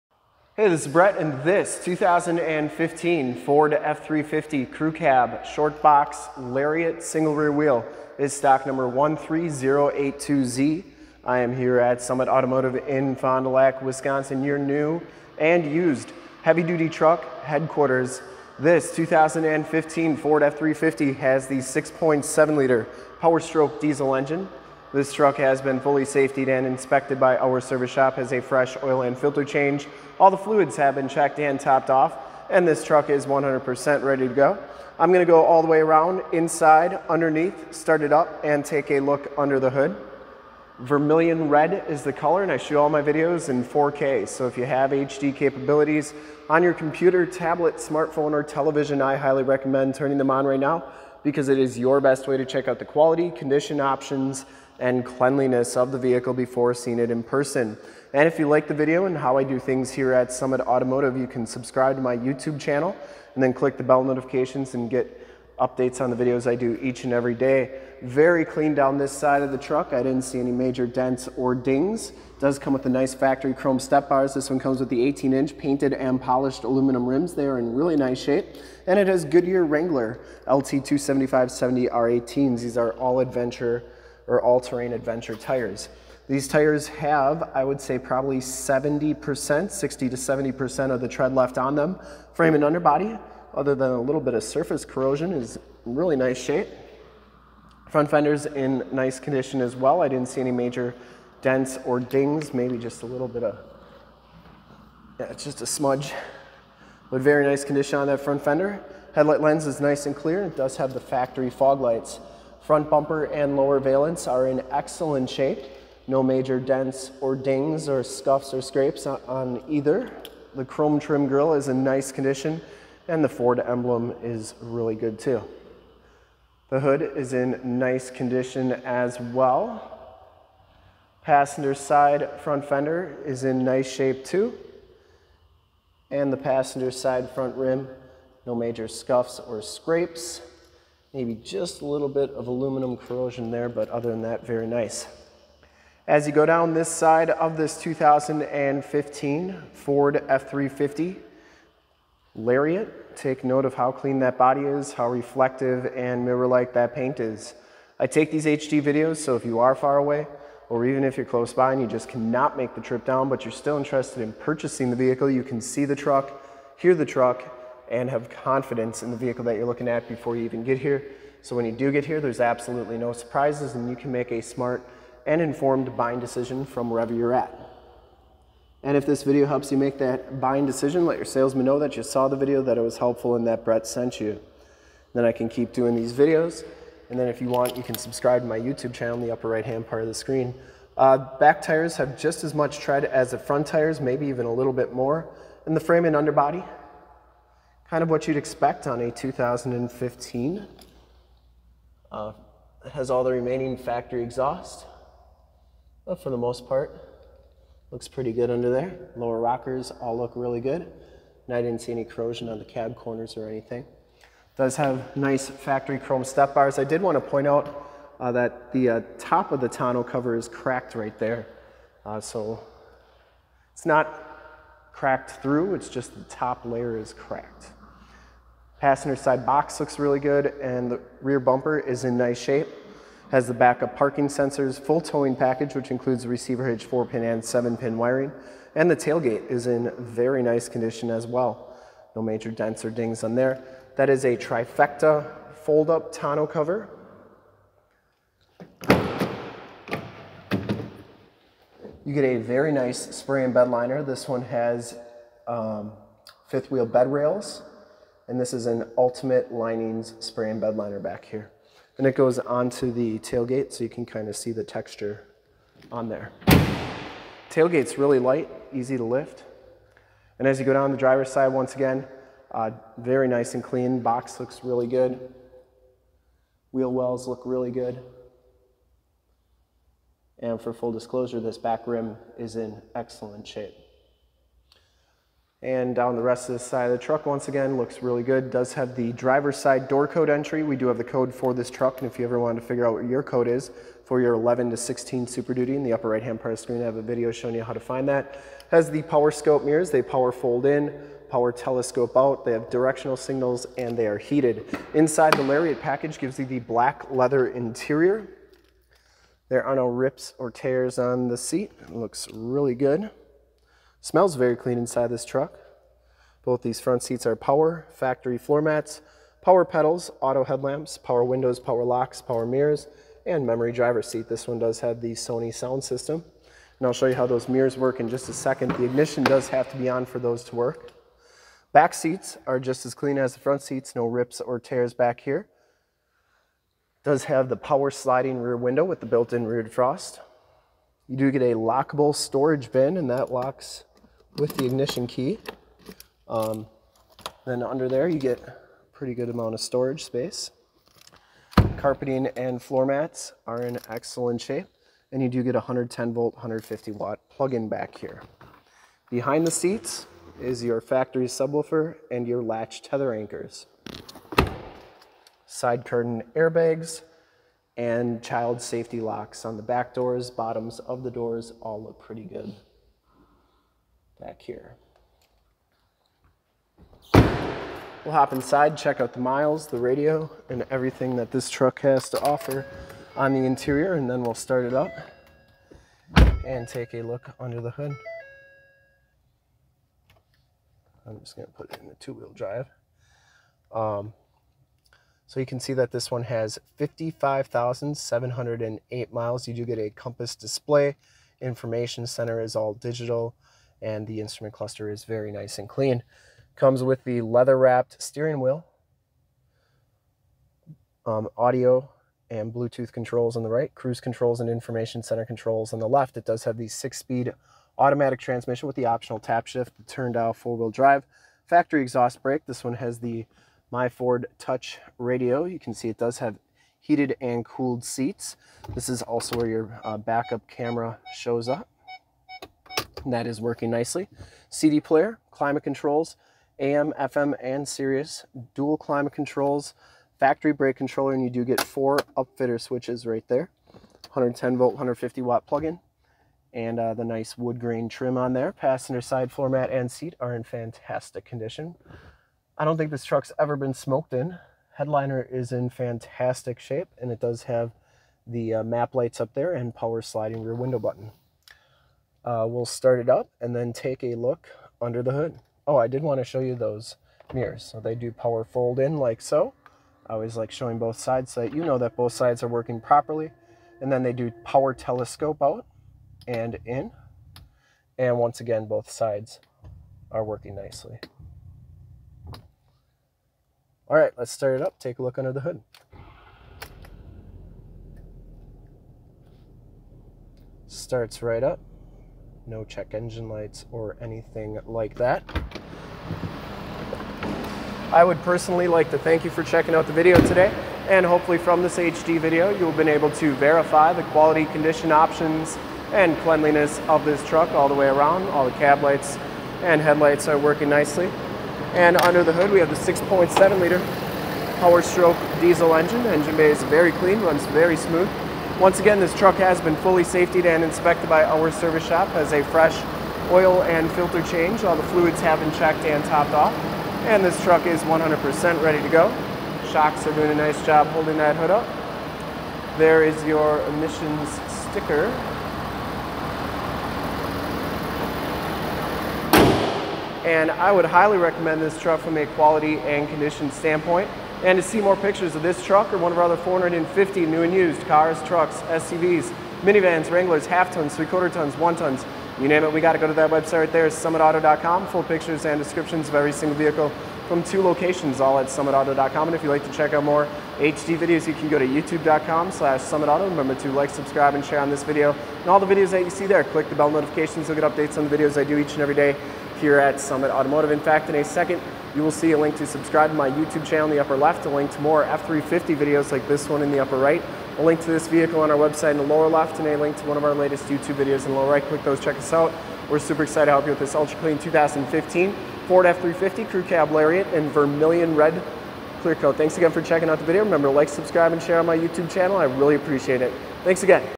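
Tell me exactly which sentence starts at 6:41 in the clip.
Information center is all digital and the instrument cluster is very nice and clean.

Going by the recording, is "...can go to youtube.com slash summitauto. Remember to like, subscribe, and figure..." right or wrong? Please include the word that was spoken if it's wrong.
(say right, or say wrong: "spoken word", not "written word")
wrong: "share", not "figure".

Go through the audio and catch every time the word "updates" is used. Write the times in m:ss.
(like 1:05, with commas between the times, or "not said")
1:05, 9:27.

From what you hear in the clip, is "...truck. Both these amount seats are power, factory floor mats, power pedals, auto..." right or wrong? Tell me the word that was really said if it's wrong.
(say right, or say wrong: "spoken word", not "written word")
wrong: "front", not "amount".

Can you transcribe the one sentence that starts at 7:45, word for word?
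Oh, I did want to show you those mirrors.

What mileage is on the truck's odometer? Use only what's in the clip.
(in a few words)
55,708 miles.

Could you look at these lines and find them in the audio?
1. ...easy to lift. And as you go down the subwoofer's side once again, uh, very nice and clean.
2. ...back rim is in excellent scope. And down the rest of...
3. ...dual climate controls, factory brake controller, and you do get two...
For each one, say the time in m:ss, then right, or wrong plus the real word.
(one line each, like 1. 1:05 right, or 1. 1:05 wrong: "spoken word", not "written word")
1. 4:28 wrong: "driver", not "subwoofer"
2. 4:41 wrong: "shape", not "scope"
3. 7:18 wrong: "four", not "two".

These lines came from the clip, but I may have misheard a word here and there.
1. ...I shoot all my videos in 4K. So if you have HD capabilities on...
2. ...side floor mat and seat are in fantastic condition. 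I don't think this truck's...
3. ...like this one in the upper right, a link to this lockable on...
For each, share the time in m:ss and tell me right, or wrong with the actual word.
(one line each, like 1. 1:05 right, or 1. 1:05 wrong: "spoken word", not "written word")
1. 0:42 right
2. 7:29 right
3. 9:36 wrong: "vehicle", not "lockable".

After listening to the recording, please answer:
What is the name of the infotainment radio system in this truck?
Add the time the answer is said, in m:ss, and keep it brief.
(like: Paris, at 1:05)
My Ford Touch, at 7:03.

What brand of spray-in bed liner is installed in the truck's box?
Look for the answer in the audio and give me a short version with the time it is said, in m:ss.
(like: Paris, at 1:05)
Ultimate Linings, at 4:18.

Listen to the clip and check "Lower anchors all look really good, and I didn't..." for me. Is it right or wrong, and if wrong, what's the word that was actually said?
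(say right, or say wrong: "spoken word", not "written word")
wrong: "rockers", not "anchors".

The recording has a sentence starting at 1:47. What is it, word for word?
But very nice condition on that front fender.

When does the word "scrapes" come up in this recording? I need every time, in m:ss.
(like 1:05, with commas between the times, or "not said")
1:58, 2:19.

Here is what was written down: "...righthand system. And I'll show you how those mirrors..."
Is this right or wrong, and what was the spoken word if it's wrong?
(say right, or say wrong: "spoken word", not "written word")
wrong: "sound", not "righthand".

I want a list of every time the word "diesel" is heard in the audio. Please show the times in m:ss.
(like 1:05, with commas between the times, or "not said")
0:23, 8:35.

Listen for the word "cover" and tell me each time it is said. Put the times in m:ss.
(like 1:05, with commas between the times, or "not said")
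3:40, 4:06.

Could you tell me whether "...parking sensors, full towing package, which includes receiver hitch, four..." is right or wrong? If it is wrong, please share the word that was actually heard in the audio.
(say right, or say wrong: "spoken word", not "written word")
right.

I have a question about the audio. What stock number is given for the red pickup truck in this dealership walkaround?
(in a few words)
13082Z.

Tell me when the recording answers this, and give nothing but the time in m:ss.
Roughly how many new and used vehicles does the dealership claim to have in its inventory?
9:06.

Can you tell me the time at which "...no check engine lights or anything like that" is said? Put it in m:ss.
8:12.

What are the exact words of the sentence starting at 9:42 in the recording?
We're super excited to help you with this Ultra Clean 2015 Ford F350 Crew Cab Lariat in Vermillion Red Clear Coat.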